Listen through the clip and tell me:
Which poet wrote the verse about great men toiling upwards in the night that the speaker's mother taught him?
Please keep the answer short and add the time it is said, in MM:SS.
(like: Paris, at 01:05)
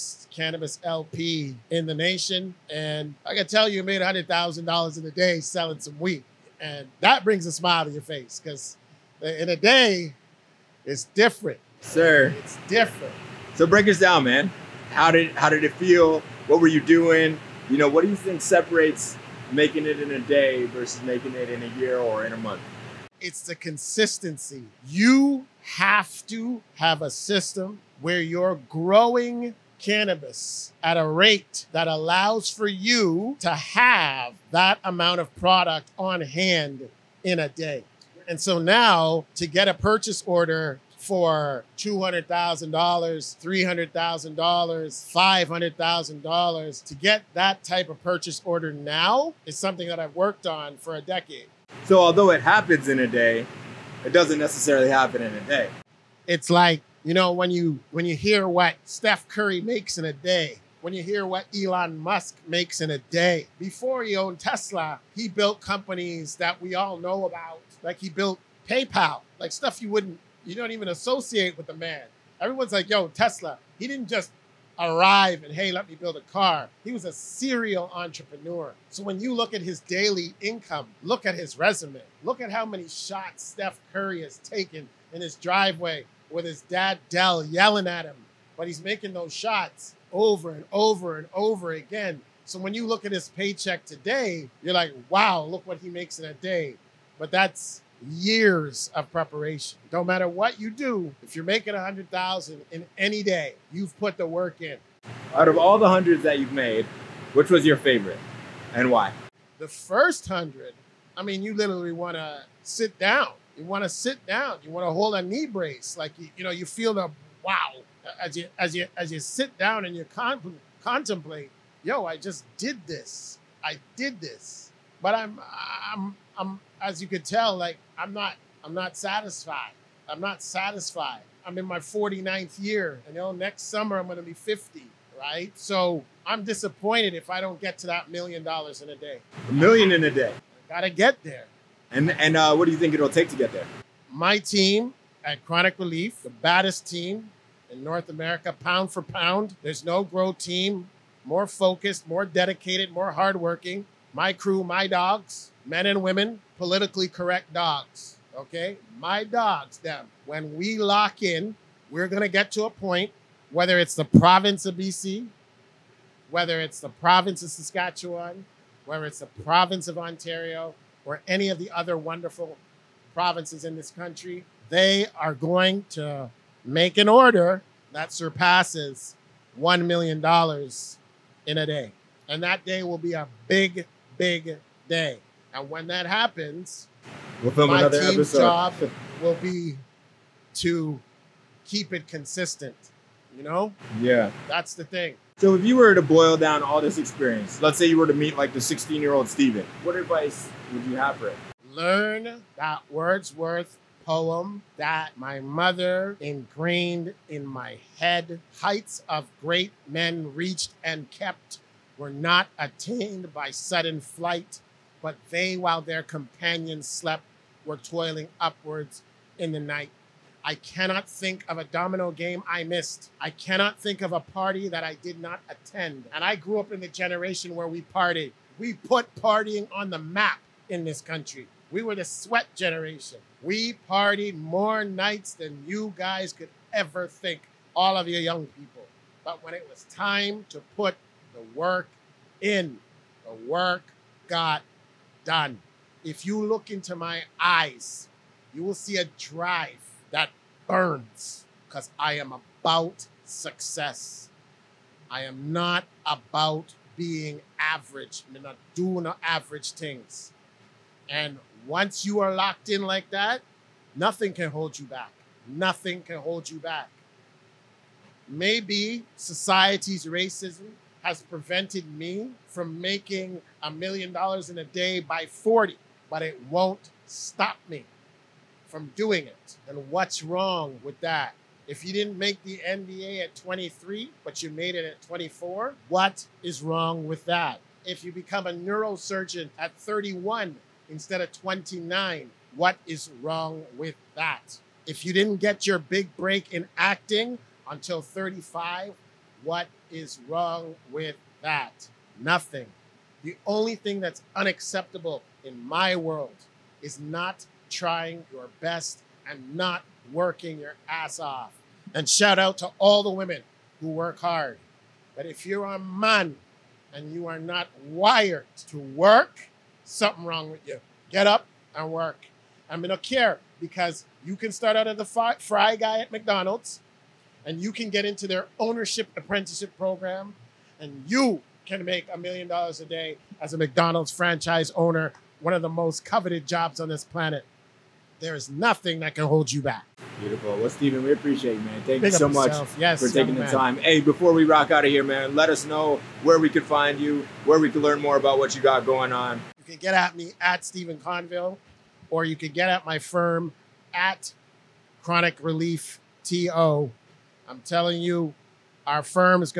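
Wordsworth, at 03:22.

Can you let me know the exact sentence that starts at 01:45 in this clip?
Out of all the hundreds that you've made, which was your favorite and why?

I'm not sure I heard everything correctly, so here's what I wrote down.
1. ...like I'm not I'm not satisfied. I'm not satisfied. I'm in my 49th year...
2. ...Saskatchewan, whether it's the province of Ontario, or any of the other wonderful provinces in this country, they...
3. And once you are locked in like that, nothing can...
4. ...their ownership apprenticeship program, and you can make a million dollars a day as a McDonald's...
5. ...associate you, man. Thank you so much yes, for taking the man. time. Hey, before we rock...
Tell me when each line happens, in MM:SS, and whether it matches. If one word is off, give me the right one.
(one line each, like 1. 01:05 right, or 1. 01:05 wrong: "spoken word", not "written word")
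1. 02:07 right
2. 02:47 right
3. 04:21 right
4. 05:28 right
5. 05:41 wrong: "appreciate", not "associate".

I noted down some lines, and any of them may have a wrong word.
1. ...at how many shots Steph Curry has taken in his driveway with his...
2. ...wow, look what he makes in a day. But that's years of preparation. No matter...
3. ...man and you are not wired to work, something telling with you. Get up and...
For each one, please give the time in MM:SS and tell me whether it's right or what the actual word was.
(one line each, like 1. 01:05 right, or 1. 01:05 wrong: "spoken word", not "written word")
1. 01:22 right
2. 01:35 right
3. 05:15 wrong: "wrong", not "telling".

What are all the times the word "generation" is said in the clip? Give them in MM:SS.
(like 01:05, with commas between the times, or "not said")
03:46, 03:52.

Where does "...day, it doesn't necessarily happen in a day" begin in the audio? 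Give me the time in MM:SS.
00:53.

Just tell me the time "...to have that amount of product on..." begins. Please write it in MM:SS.
00:33.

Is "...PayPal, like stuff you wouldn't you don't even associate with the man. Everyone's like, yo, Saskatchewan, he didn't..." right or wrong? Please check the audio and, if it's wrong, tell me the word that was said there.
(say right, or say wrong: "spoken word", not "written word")
wrong: "Tesla", not "Saskatchewan".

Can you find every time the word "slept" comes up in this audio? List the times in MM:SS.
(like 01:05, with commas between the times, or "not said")
03:36.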